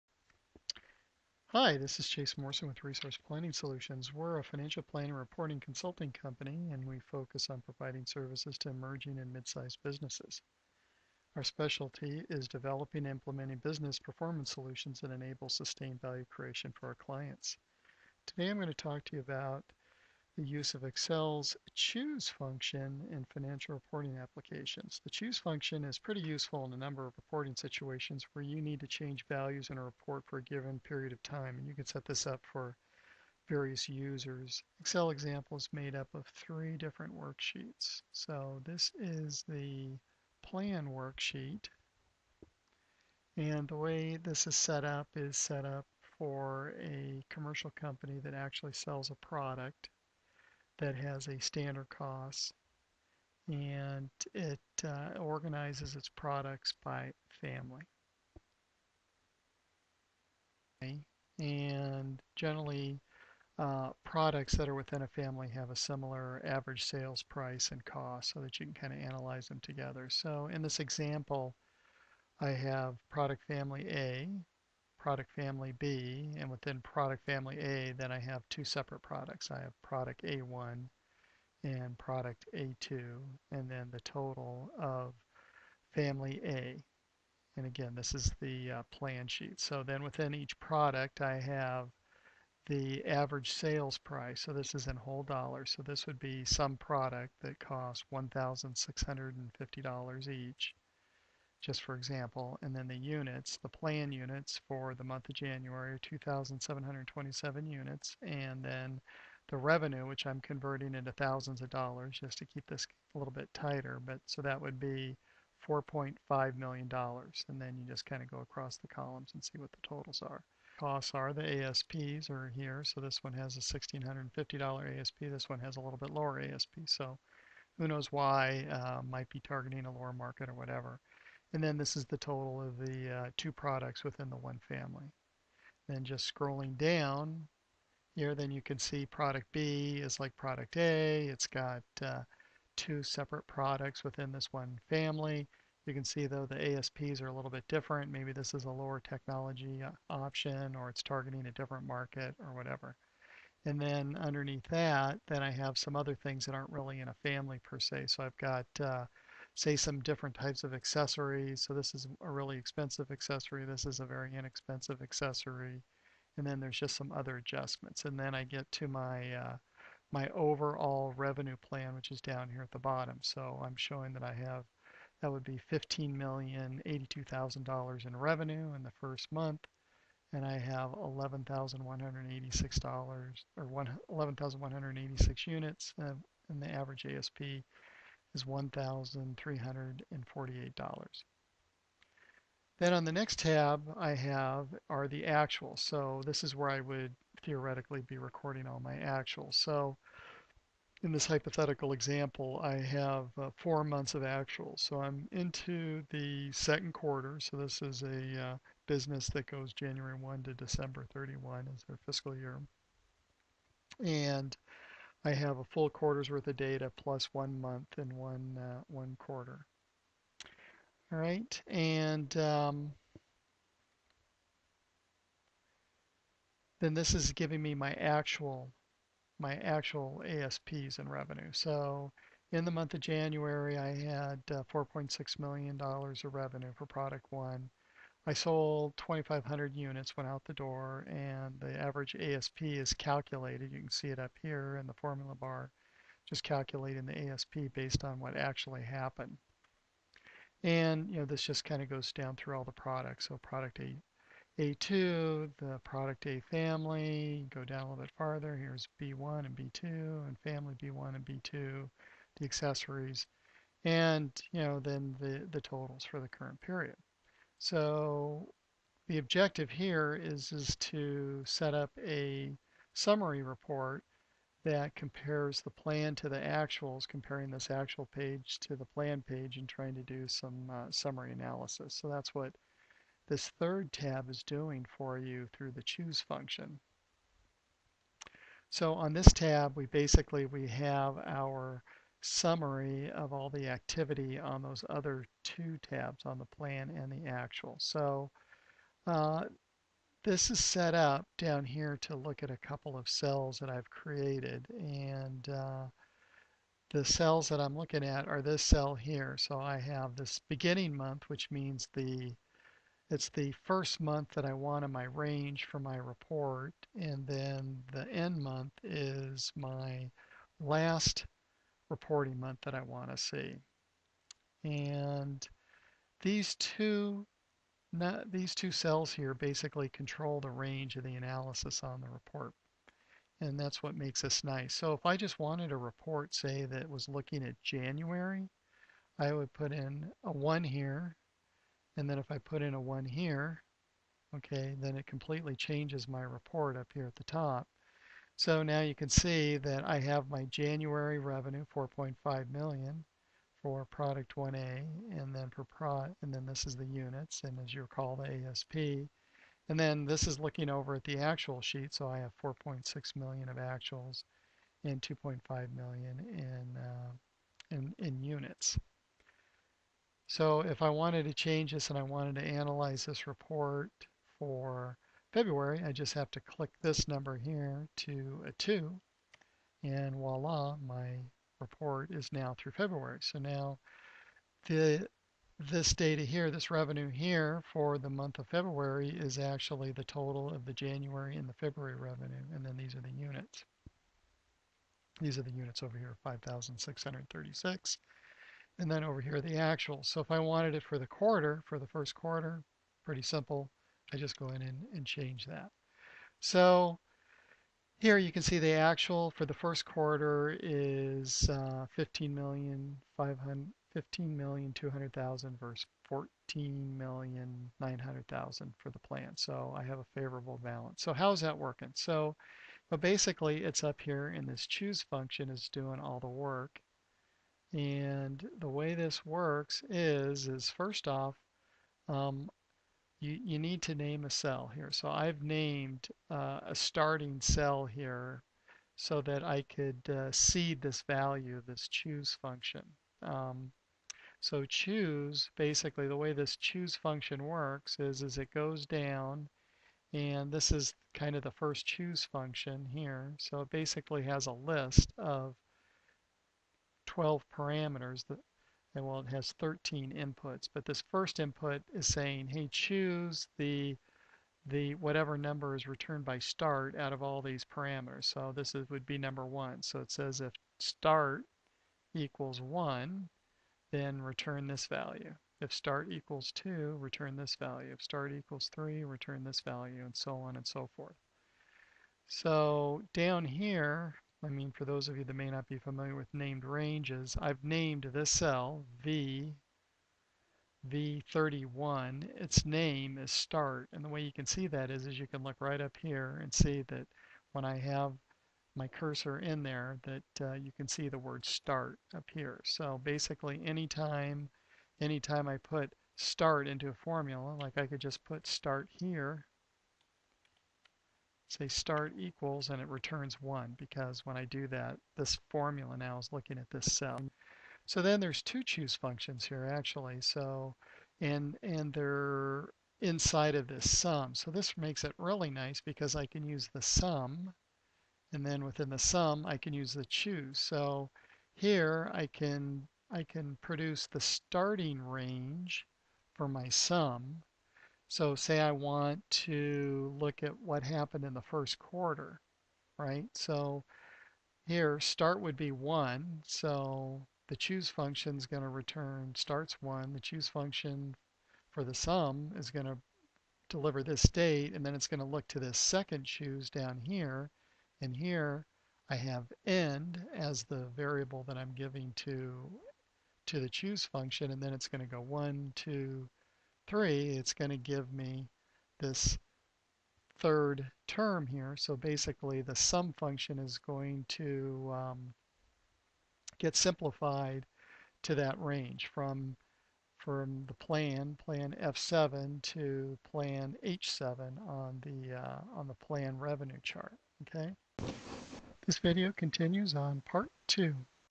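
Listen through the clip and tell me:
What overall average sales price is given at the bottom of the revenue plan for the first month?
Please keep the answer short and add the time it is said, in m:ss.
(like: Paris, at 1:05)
$1,348, at 3:08.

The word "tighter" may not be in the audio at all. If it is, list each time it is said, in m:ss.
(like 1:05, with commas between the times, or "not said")
1:53.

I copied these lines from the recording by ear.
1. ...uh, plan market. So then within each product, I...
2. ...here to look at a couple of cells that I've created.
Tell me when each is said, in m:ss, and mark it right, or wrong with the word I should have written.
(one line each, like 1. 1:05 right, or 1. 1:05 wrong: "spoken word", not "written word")
1. 1:28 wrong: "sheet", not "market"
2. 5:01 right.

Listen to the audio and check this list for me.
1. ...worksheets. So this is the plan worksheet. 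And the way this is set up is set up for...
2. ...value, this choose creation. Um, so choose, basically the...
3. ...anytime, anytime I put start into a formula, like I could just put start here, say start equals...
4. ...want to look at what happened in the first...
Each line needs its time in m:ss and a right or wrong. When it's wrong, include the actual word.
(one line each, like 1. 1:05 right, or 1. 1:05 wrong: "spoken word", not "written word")
1. 0:37 right
2. 7:21 wrong: "function", not "creation"
3. 8:23 right
4. 8:58 right.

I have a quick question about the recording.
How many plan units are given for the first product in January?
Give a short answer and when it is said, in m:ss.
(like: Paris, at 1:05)
2,727, at 1:46.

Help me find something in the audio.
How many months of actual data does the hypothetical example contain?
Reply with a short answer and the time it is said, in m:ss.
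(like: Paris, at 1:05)
4, at 3:23.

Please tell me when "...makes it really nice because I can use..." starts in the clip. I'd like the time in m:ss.
8:44.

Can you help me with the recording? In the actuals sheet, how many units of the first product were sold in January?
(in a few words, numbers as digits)
2,500.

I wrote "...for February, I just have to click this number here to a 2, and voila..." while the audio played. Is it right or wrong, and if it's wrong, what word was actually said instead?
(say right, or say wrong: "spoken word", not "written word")
right.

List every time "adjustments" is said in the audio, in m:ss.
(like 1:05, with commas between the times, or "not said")
2:47.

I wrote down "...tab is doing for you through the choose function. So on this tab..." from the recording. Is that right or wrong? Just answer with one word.
right.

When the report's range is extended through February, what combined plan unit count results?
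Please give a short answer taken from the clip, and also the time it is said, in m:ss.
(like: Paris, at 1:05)
5,636, at 6:36.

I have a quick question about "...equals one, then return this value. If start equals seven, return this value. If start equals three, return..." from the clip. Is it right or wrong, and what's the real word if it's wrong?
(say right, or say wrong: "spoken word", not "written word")
wrong: "two", not "seven".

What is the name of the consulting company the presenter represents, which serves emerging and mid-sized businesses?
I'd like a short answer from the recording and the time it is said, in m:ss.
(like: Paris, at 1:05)
Resource Planning Solutions, at 0:02.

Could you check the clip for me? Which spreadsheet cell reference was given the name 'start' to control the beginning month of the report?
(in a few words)
V31.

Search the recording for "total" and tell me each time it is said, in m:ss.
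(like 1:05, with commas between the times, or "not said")
1:24, 1:59, 2:12, 4:25, 6:30.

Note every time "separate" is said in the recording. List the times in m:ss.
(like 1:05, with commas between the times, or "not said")
1:18, 2:23.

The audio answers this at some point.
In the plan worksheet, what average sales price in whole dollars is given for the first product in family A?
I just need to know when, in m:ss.
1:38.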